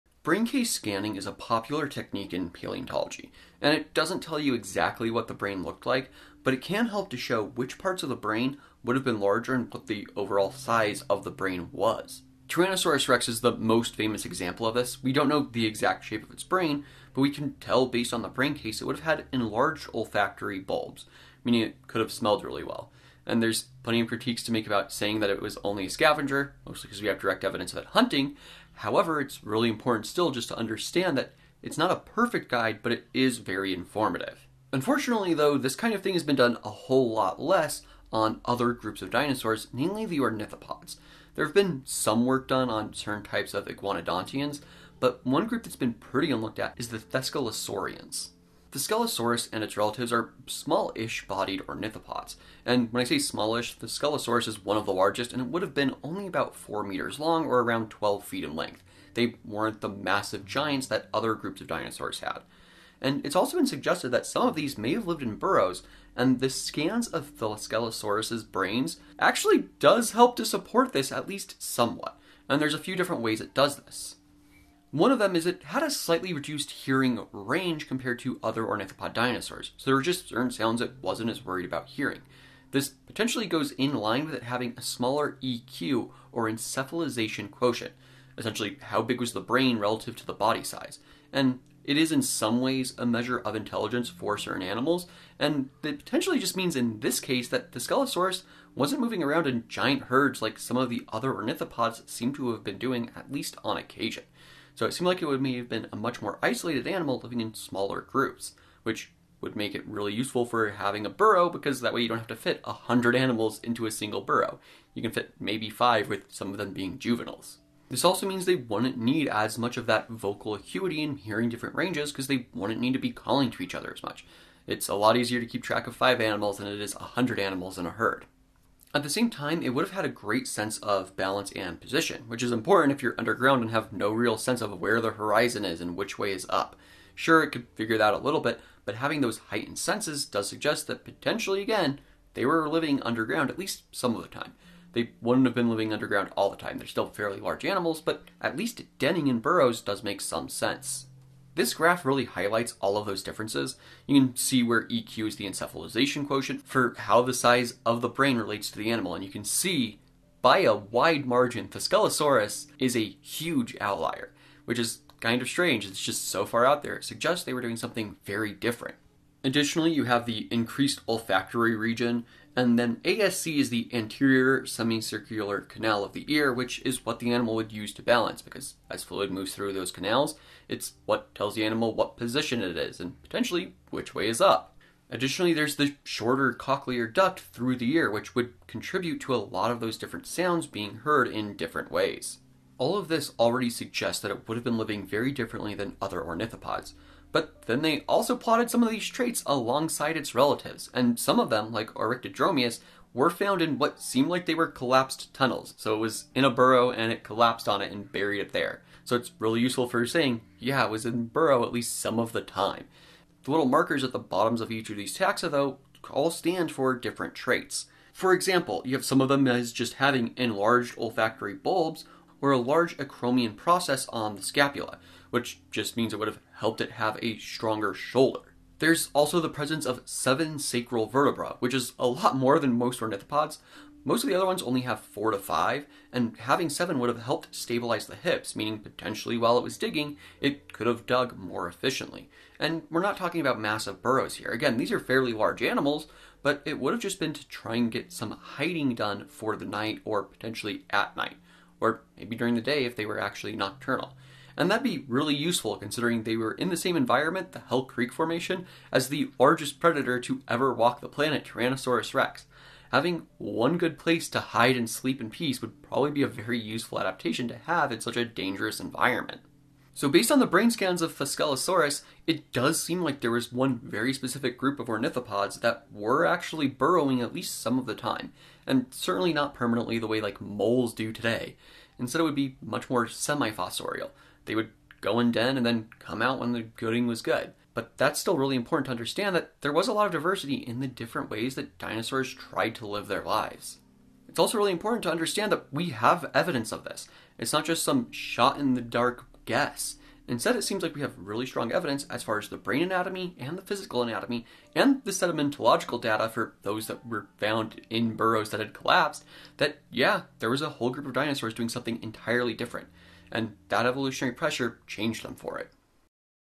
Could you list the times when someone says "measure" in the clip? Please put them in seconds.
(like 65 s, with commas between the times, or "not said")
93 s.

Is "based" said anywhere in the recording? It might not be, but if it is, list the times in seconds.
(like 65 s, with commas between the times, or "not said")
17 s, 270 s.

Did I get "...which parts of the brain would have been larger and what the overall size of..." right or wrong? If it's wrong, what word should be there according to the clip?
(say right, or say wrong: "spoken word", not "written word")
right.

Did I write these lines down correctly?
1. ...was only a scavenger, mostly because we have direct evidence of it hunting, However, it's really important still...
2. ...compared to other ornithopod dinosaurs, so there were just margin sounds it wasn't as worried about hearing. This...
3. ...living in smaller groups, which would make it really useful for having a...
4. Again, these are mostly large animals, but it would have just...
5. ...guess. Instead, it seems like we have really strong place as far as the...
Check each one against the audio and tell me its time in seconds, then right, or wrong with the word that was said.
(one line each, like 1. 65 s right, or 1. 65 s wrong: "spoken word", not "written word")
1. 25 s right
2. 77 s wrong: "certain", not "margin"
3. 107 s right
4. 244 s wrong: "fairly", not "mostly"
5. 299 s wrong: "evidence", not "place".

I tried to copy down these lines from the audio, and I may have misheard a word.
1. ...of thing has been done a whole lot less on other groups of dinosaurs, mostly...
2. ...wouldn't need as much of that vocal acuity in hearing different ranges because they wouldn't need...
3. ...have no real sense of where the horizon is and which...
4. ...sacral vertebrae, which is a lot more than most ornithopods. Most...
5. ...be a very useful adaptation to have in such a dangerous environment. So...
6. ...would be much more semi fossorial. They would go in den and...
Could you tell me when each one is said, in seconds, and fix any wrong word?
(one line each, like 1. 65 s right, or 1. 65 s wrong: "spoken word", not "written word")
1. 35 s wrong: "namely", not "mostly"
2. 118 s right
3. 133 s right
4. 230 s right
5. 266 s right
6. 282 s right.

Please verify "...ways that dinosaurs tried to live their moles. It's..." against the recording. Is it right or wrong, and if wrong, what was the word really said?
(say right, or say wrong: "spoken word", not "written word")
wrong: "lives", not "moles".